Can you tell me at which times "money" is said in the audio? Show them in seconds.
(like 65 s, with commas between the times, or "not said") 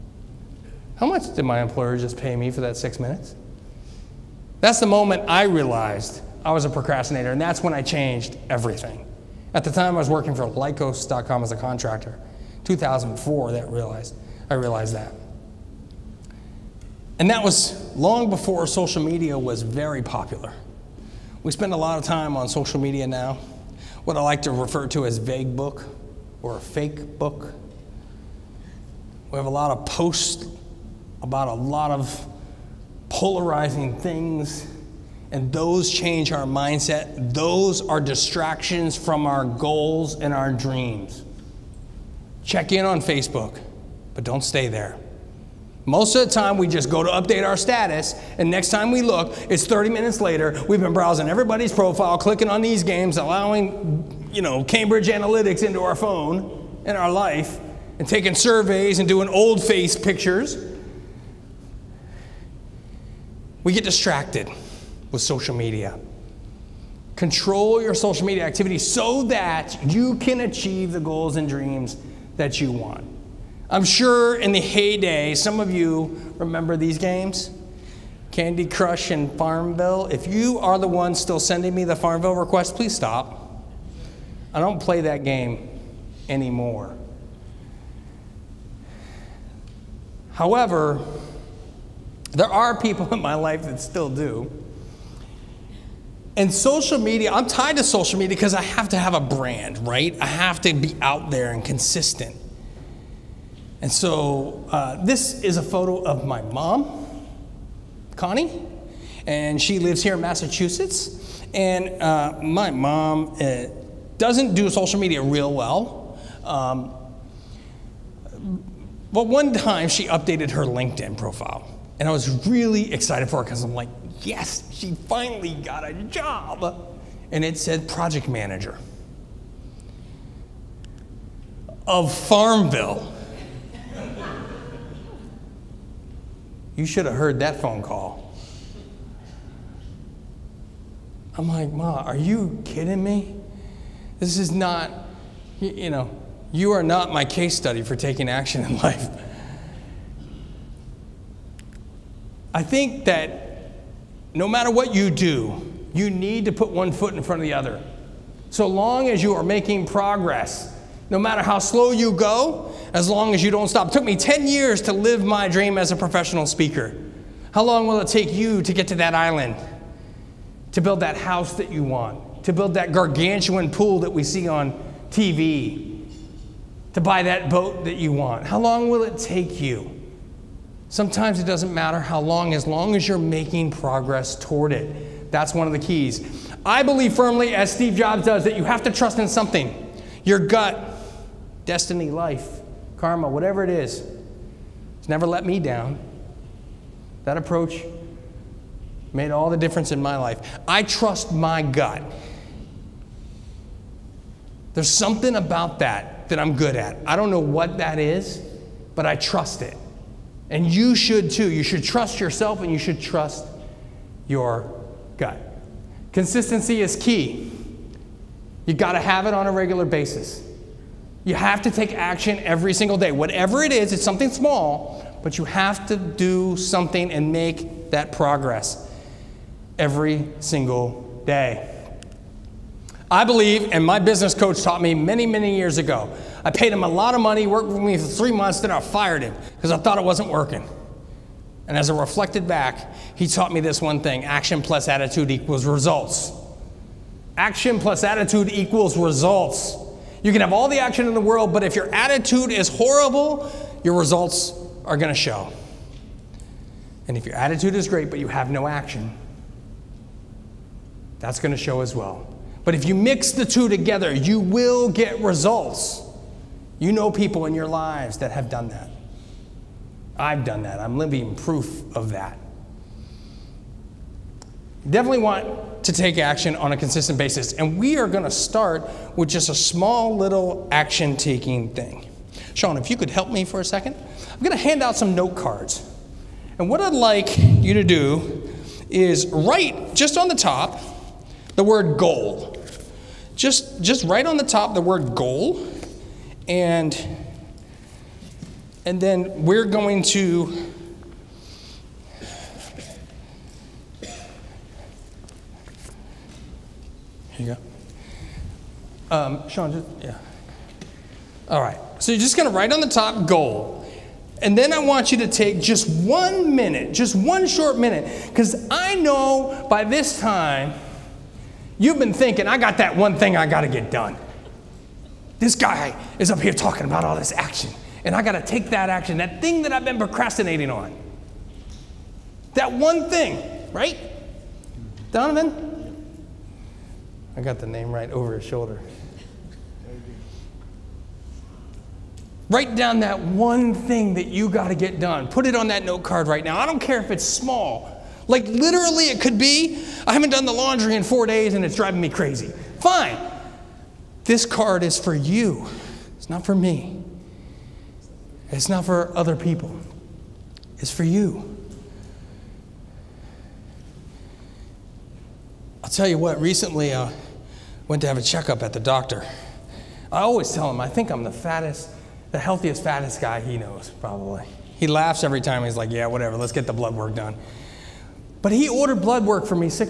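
237 s.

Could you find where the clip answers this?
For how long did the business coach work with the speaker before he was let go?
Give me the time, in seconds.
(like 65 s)
238 s.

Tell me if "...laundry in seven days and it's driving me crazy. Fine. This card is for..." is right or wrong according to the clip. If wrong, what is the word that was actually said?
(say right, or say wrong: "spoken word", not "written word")
wrong: "four", not "seven".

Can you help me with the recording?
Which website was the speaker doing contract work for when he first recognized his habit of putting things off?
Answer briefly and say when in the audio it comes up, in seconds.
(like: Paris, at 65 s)
Lycos.com, at 10 s.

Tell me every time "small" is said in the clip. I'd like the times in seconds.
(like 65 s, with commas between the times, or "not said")
224 s, 279 s, 347 s.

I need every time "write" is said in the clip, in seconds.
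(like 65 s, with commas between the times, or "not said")
289 s, 294 s, 312 s, 342 s.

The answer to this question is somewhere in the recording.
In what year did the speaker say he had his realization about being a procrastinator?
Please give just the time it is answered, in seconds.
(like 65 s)
12 s.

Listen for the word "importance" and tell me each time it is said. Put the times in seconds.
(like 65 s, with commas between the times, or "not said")
not said.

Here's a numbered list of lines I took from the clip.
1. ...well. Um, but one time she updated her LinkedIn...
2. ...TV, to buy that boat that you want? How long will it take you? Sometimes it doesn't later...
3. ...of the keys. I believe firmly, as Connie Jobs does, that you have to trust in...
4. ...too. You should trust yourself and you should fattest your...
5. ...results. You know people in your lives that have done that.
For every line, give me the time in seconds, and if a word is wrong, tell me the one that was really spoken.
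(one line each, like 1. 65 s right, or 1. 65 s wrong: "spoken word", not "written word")
1. 115 s right
2. 175 s wrong: "matter", not "later"
3. 185 s wrong: "Steve", not "Connie"
4. 211 s wrong: "trust", not "fattest"
5. 265 s right.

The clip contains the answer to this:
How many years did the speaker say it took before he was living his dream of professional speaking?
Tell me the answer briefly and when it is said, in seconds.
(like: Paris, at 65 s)
10, at 164 s.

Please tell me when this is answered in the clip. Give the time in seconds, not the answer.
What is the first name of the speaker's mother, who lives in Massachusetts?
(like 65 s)
108 s.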